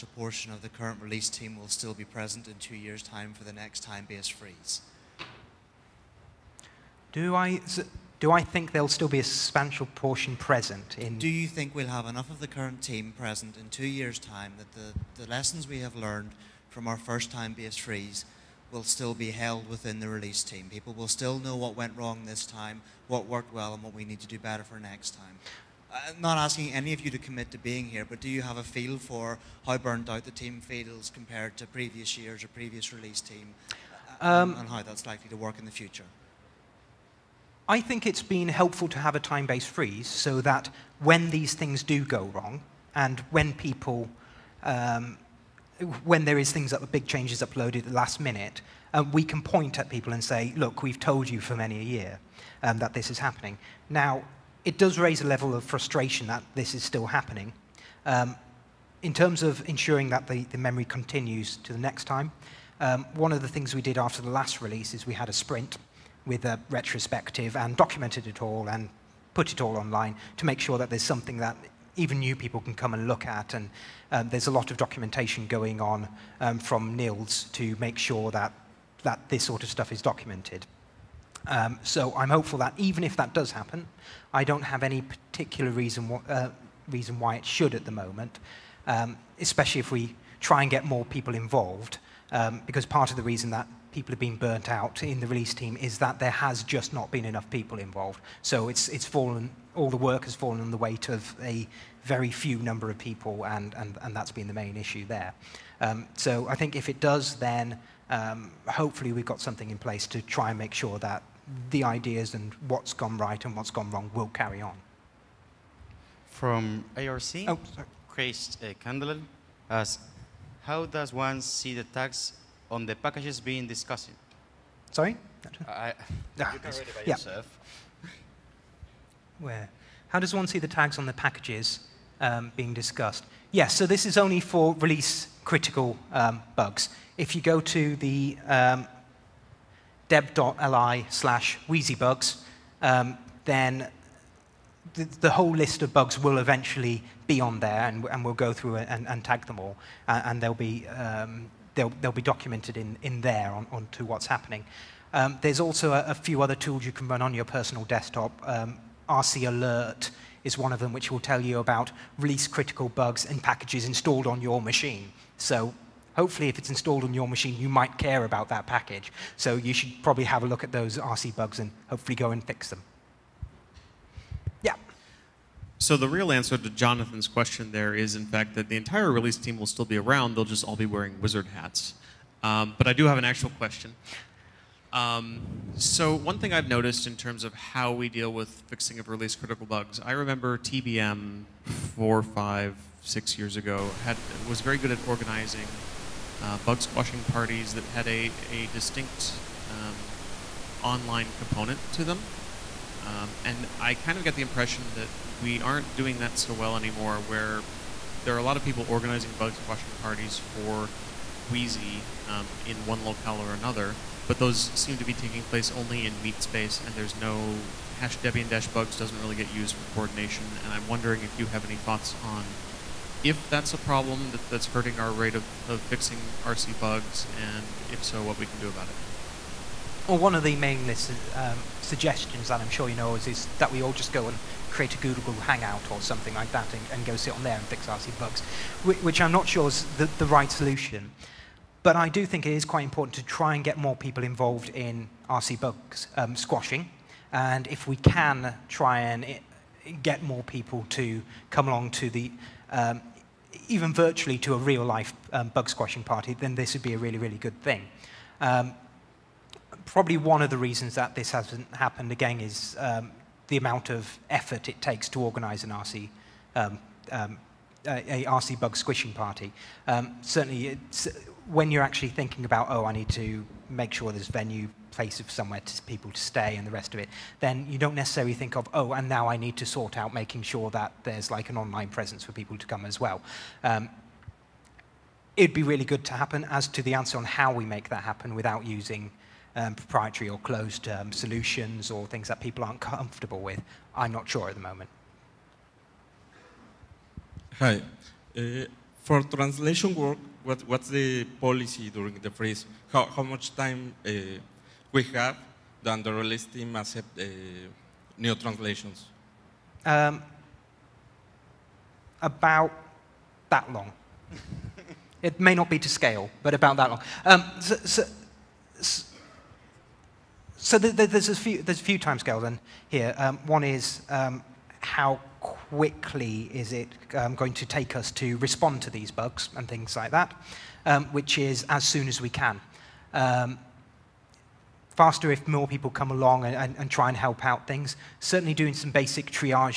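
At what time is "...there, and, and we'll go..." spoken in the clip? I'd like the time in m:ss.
2:27.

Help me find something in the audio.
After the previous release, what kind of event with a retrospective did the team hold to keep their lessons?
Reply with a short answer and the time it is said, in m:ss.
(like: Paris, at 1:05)
a sprint, at 1:05.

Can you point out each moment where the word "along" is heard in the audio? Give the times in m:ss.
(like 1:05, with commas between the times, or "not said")
4:11, 5:36.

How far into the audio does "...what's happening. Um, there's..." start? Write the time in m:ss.
2:34.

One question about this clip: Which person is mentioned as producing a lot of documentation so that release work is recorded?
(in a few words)
Niels.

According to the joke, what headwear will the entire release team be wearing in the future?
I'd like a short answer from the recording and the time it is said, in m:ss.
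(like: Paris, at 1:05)
wizard hats, at 3:01.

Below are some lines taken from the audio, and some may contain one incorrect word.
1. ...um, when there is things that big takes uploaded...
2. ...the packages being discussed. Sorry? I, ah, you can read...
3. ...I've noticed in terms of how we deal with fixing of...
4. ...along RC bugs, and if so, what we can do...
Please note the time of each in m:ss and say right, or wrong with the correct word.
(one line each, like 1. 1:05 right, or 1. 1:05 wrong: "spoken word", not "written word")
1. 0:44 wrong: "changes", not "takes"
2. 2:02 right
3. 3:06 right
4. 3:45 wrong: "fixing", not "along".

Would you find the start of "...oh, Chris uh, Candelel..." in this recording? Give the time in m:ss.
1:57.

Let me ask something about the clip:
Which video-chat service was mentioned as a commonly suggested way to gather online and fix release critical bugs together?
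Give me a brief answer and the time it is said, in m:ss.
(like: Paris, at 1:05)
Google Hangout, at 3:54.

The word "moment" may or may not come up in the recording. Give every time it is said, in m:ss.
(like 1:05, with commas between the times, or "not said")
1:27, 4:54.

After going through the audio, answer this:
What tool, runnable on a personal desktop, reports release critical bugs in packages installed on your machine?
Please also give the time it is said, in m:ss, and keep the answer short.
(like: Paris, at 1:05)
RC Alert, at 2:39.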